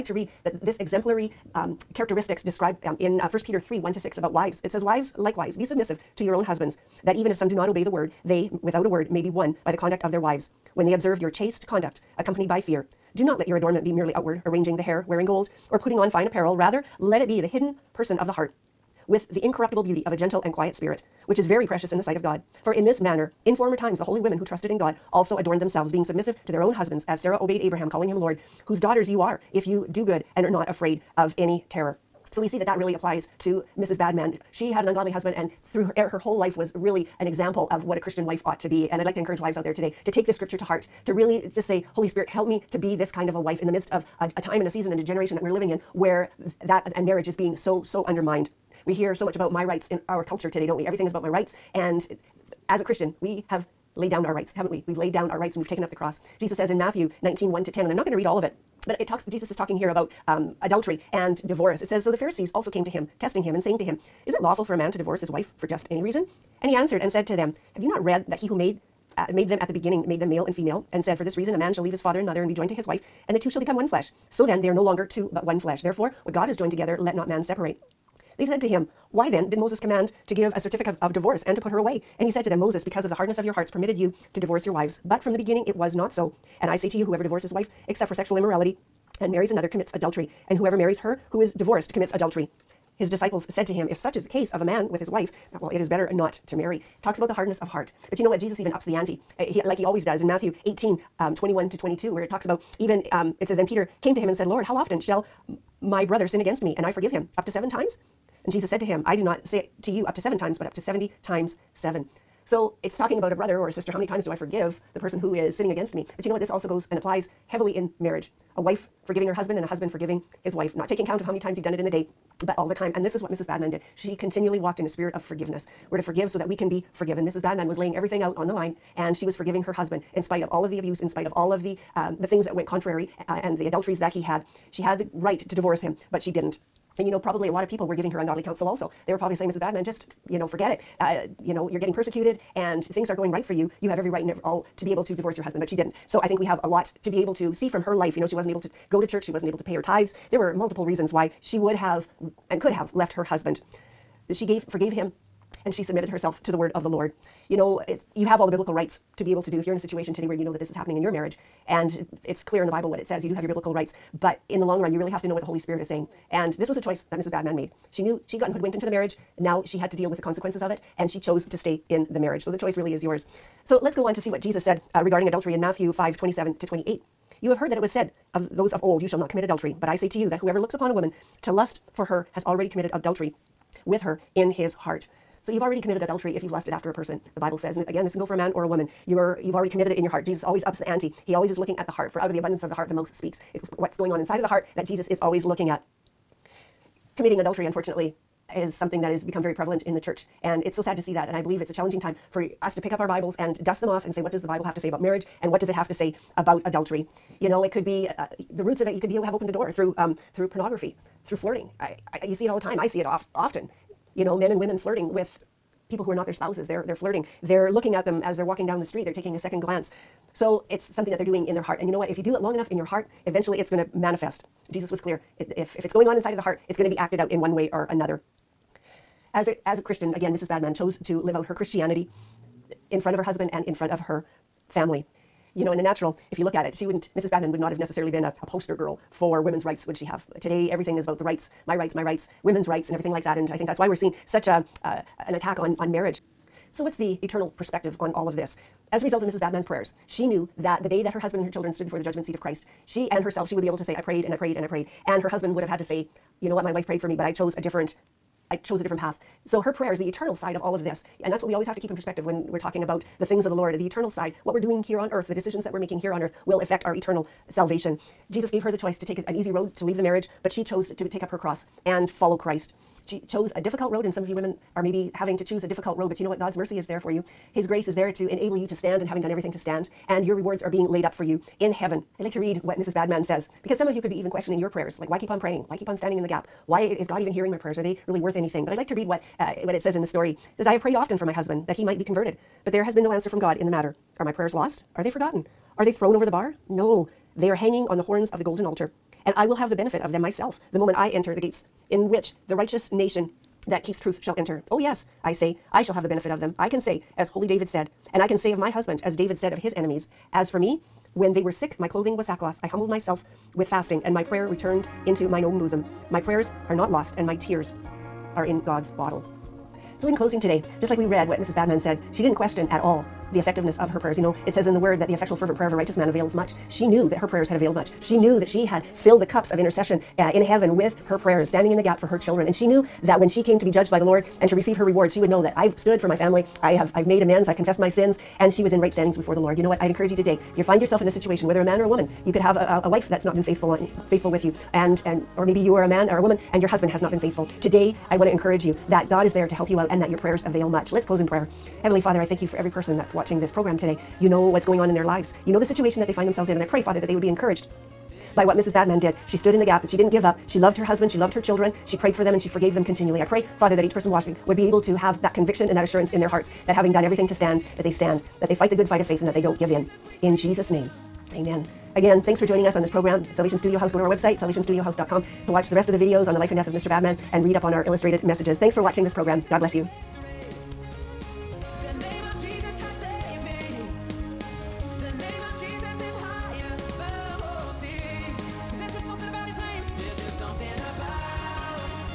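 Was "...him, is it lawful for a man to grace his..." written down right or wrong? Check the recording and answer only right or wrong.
wrong.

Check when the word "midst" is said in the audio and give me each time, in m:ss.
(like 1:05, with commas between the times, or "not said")
0:43.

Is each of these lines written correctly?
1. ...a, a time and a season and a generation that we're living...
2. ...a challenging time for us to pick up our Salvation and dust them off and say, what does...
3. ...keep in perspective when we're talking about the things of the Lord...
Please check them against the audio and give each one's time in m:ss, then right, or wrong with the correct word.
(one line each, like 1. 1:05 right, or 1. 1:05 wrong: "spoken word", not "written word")
1. 0:44 right
2. 3:21 wrong: "Bibles", not "Salvation"
3. 4:21 right.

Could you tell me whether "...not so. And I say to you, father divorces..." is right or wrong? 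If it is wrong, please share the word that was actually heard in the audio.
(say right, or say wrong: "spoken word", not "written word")
wrong: "whoever", not "father".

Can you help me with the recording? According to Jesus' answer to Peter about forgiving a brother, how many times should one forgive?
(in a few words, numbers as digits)
70 times seven.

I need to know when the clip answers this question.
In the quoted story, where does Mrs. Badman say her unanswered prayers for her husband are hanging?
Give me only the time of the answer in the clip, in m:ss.
4:58.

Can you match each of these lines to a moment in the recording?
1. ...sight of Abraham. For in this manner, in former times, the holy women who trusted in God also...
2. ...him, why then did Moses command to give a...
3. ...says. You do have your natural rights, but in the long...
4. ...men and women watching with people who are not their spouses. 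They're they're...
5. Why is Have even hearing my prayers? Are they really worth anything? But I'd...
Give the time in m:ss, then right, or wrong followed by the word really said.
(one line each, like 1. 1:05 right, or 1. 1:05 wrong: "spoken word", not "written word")
1. 0:22 wrong: "God", not "Abraham"
2. 1:18 right
3. 2:43 wrong: "biblical", not "natural"
4. 3:34 wrong: "flirting", not "watching"
5. 4:46 wrong: "God", not "Have".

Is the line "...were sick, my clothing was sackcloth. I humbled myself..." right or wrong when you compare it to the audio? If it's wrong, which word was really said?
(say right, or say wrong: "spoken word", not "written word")
right.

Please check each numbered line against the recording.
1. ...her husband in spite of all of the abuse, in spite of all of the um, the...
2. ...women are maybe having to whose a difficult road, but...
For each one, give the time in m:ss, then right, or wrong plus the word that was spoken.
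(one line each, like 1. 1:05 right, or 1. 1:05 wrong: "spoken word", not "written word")
1. 2:09 right
2. 4:34 wrong: "choose", not "whose".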